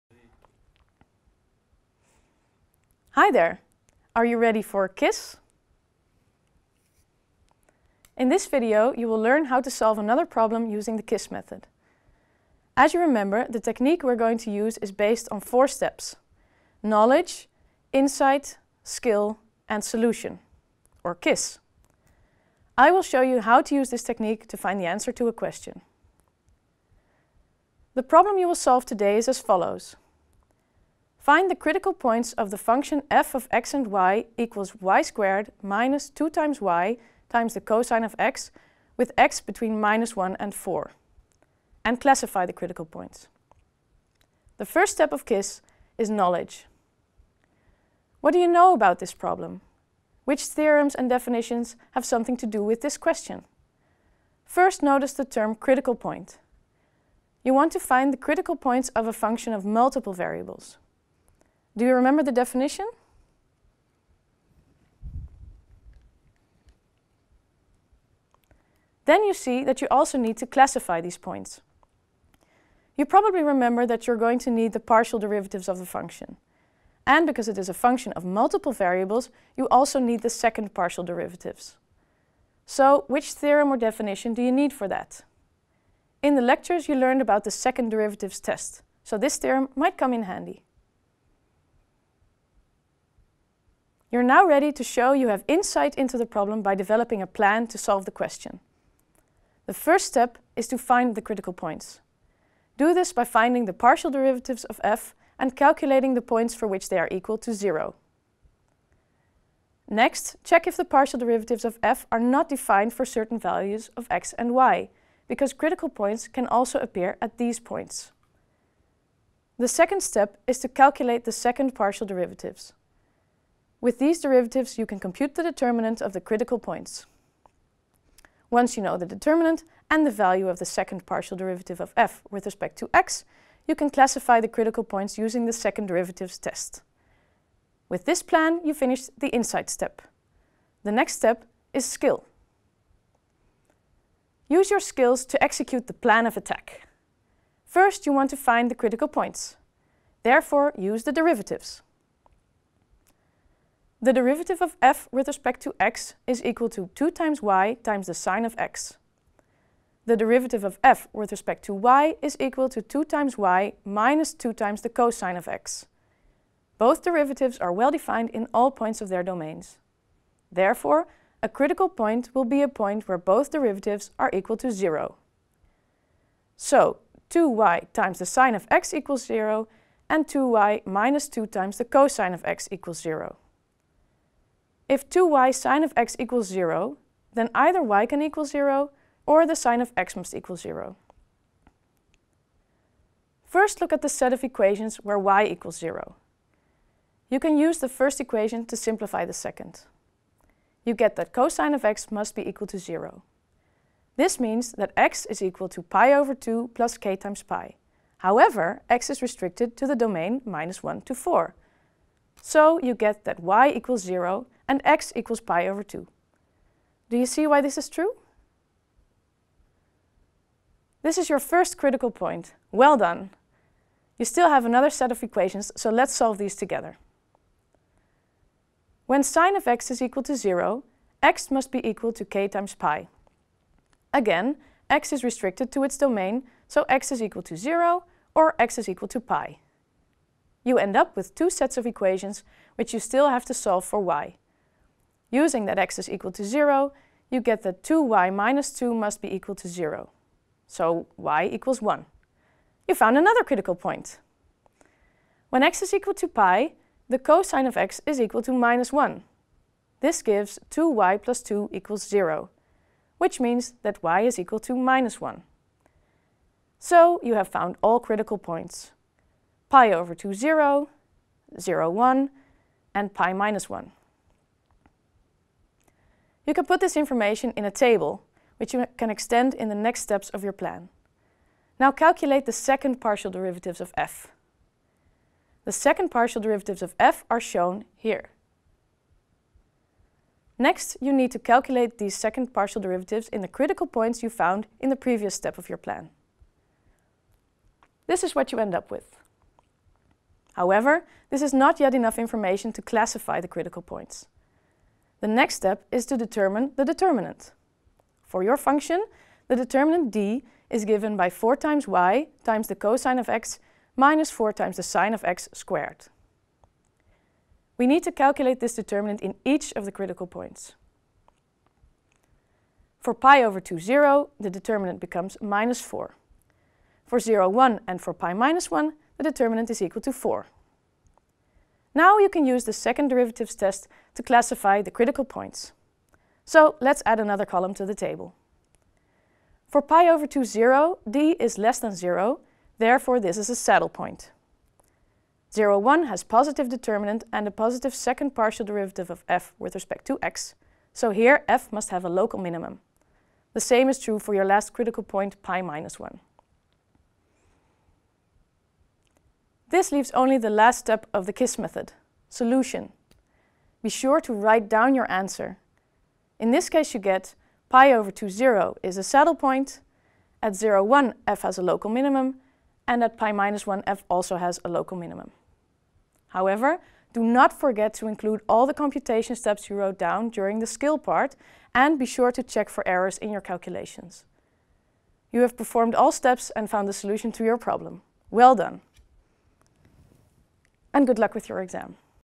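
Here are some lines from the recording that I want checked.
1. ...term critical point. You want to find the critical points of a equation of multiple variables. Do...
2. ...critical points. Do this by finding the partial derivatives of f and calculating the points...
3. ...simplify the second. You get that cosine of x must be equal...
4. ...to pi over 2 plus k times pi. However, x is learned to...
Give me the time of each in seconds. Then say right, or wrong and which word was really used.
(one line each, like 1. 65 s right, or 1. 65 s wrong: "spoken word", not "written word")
1. 55 s wrong: "function", not "equation"
2. 101 s right
3. 198 s right
4. 205 s wrong: "restricted", not "learned".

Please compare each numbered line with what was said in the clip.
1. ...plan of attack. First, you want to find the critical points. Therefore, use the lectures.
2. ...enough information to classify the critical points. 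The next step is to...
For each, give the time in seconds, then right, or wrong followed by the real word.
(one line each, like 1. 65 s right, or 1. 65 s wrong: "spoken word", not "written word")
1. 145 s wrong: "derivatives", not "lectures"
2. 301 s right.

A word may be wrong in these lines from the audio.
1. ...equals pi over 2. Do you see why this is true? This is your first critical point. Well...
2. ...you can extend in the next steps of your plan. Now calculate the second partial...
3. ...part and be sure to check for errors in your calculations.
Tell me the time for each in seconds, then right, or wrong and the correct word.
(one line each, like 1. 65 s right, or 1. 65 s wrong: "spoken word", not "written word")
1. 215 s right
2. 278 s right
3. 380 s right.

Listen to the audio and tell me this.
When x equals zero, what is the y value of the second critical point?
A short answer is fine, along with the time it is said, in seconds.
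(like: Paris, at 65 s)
1, at 251 s.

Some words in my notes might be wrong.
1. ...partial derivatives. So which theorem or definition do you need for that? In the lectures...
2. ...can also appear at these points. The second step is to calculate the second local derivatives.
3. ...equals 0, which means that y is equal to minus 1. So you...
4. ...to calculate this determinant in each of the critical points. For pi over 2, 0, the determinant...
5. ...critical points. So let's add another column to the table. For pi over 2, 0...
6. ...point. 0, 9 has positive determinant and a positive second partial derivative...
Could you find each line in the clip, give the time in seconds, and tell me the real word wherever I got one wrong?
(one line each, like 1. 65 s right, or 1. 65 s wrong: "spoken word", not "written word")
1. 80 s right
2. 116 s wrong: "partial", not "local"
3. 261 s right
4. 318 s right
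5. 334 s right
6. 343 s wrong: "1", not "9".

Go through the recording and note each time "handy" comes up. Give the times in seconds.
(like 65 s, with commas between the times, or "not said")
90 s.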